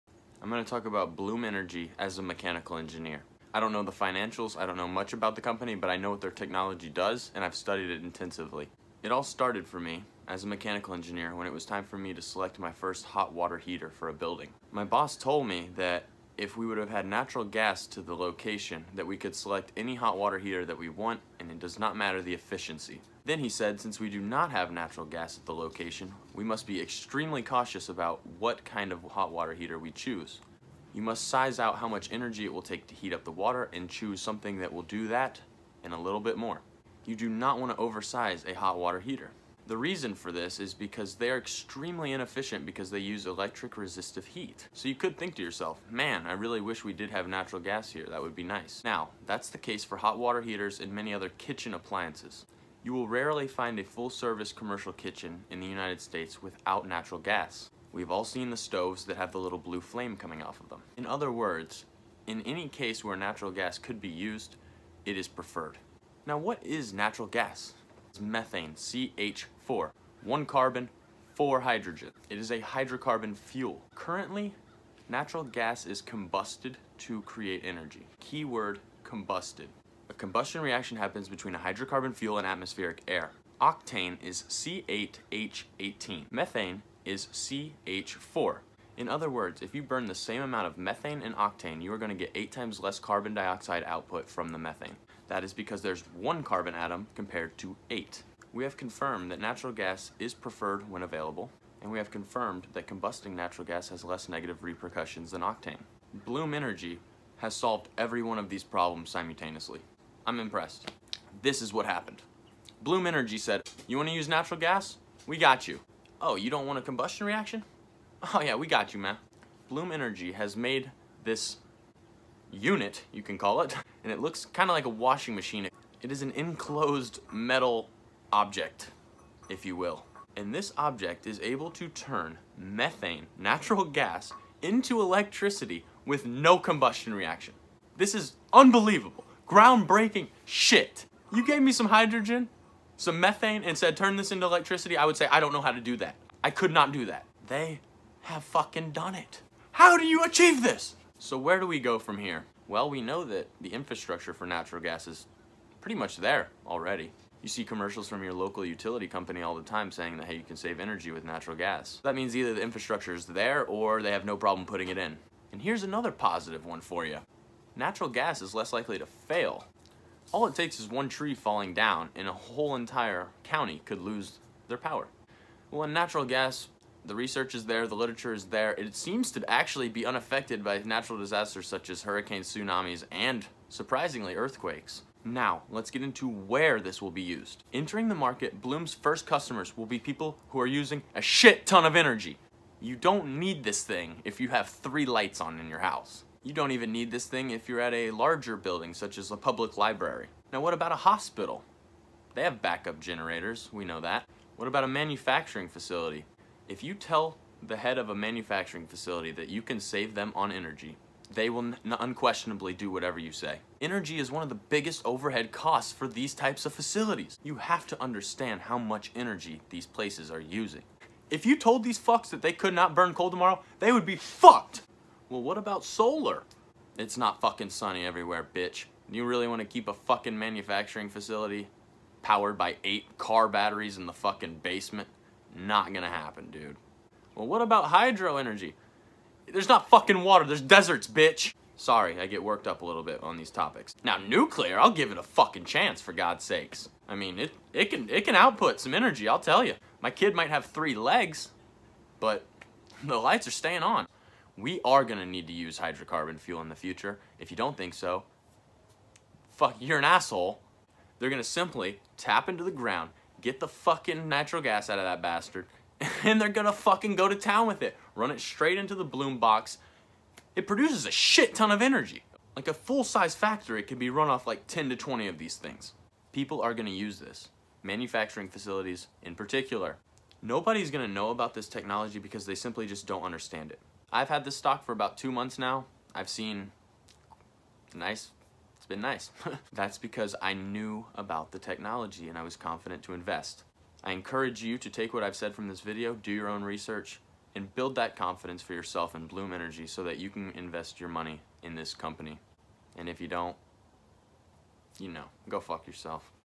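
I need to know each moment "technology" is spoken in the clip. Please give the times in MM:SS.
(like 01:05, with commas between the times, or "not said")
00:06, 04:41, 04:51.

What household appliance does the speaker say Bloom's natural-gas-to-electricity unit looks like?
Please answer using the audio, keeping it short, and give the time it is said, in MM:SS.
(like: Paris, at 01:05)
washing machine, at 02:04.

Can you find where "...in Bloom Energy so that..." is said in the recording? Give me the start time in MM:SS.
04:59.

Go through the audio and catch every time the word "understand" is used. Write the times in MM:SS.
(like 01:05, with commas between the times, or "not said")
03:38, 04:43.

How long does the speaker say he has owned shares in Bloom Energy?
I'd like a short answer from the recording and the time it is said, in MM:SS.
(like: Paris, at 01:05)
2 months, at 04:45.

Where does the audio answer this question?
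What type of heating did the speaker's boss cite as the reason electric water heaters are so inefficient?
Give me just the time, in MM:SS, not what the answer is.
00:43.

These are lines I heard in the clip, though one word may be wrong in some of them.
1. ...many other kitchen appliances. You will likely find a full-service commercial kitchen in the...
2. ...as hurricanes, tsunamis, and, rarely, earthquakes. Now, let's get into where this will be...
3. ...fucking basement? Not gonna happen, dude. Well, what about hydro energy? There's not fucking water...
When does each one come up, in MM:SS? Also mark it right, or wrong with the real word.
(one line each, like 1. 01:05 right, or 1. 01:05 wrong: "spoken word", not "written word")
1. 00:50 wrong: "rarely", not "likely"
2. 03:01 wrong: "surprisingly", not "rarely"
3. 03:54 right.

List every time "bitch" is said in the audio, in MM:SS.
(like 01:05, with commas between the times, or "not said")
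03:48, 04:01.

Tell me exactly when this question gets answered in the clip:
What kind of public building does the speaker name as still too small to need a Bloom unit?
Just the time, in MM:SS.
03:19.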